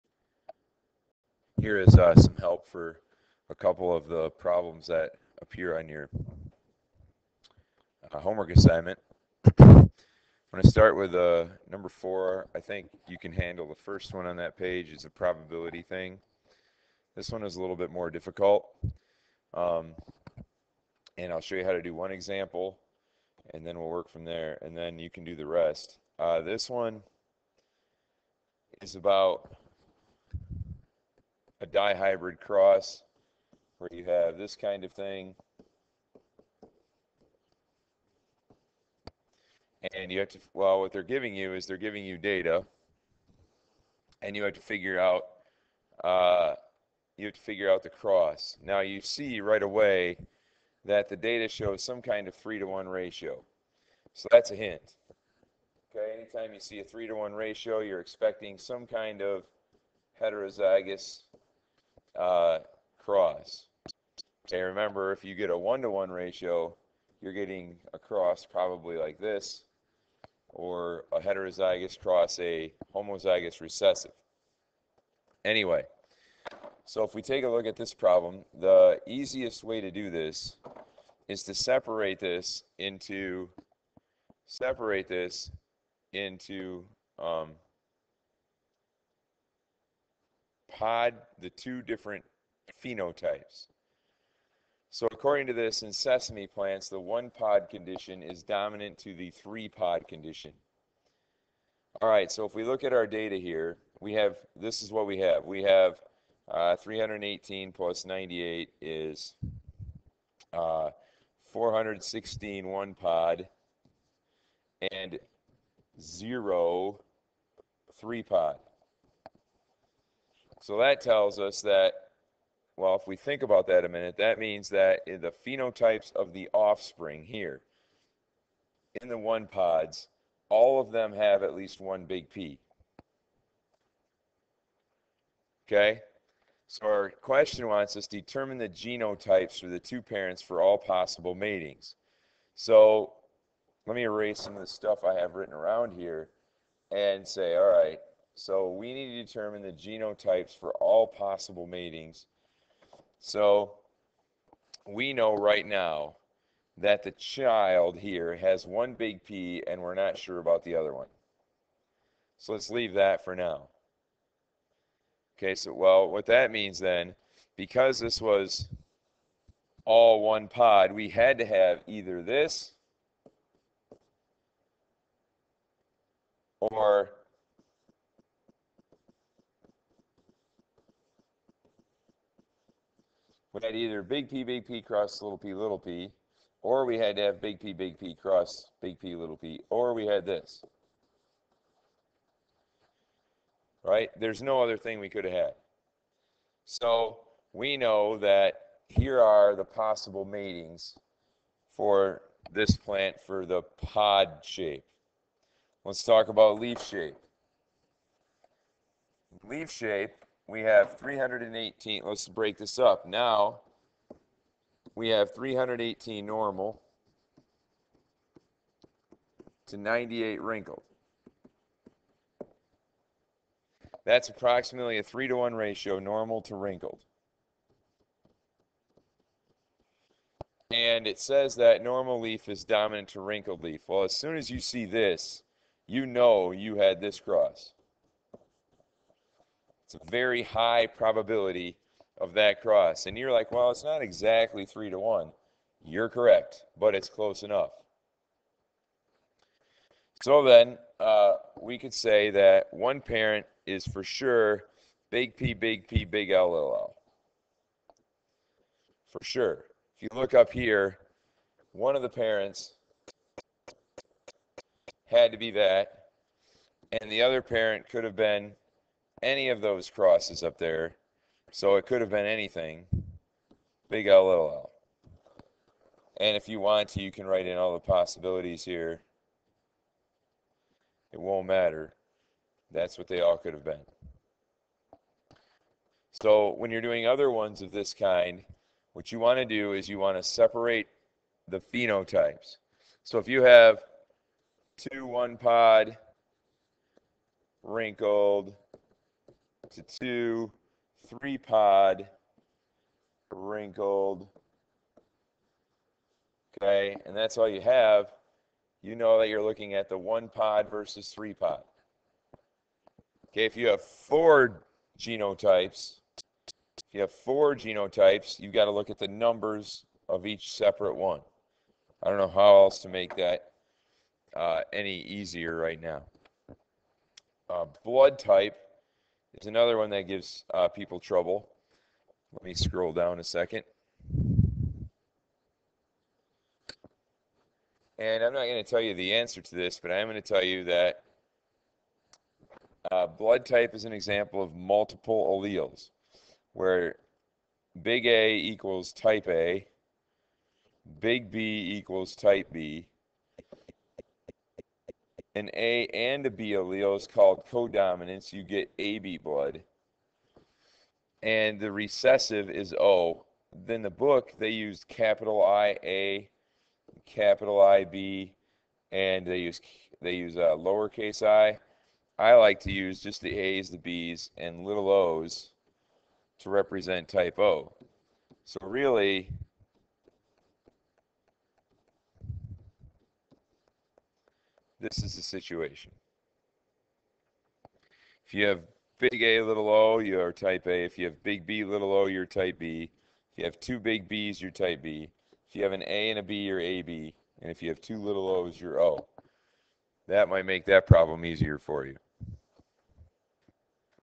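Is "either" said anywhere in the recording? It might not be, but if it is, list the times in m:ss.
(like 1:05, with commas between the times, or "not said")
2:51, 3:03.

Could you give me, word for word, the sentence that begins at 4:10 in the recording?
So then uh, we could say that one parent is for sure big P, big P, big LLL.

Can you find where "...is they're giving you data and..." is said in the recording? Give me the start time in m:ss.
0:41.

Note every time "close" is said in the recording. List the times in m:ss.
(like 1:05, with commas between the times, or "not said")
4:07.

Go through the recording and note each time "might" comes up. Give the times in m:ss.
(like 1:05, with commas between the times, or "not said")
6:40.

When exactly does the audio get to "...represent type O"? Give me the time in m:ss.
6:16.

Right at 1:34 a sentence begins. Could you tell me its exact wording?
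So according to this, in sesame plants, the one pod condition is dominant to the three pod condition.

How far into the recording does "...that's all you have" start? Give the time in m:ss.
5:07.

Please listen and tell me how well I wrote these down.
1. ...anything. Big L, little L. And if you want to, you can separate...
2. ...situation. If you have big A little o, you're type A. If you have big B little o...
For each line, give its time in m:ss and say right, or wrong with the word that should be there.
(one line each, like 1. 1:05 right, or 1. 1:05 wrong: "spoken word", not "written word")
1. 4:32 wrong: "write", not "separate"
2. 6:25 right.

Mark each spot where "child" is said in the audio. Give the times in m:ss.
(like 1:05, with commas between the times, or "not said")
2:37.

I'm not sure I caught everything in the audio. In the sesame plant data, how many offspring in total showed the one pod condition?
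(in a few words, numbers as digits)
416.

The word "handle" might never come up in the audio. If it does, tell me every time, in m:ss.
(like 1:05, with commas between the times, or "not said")
0:13.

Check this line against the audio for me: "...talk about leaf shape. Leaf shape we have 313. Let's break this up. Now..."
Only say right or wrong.
wrong.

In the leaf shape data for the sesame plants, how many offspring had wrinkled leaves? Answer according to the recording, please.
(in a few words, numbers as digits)
98.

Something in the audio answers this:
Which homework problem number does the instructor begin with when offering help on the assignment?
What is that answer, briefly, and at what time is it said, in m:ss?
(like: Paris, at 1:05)
4, at 0:11.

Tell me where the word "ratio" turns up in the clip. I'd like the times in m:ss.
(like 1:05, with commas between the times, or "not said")
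0:52, 0:57, 1:06, 3:45.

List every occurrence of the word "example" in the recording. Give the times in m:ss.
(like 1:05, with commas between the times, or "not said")
0:22, 5:43.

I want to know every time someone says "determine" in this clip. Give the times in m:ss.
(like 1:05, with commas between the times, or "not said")
2:18, 2:29.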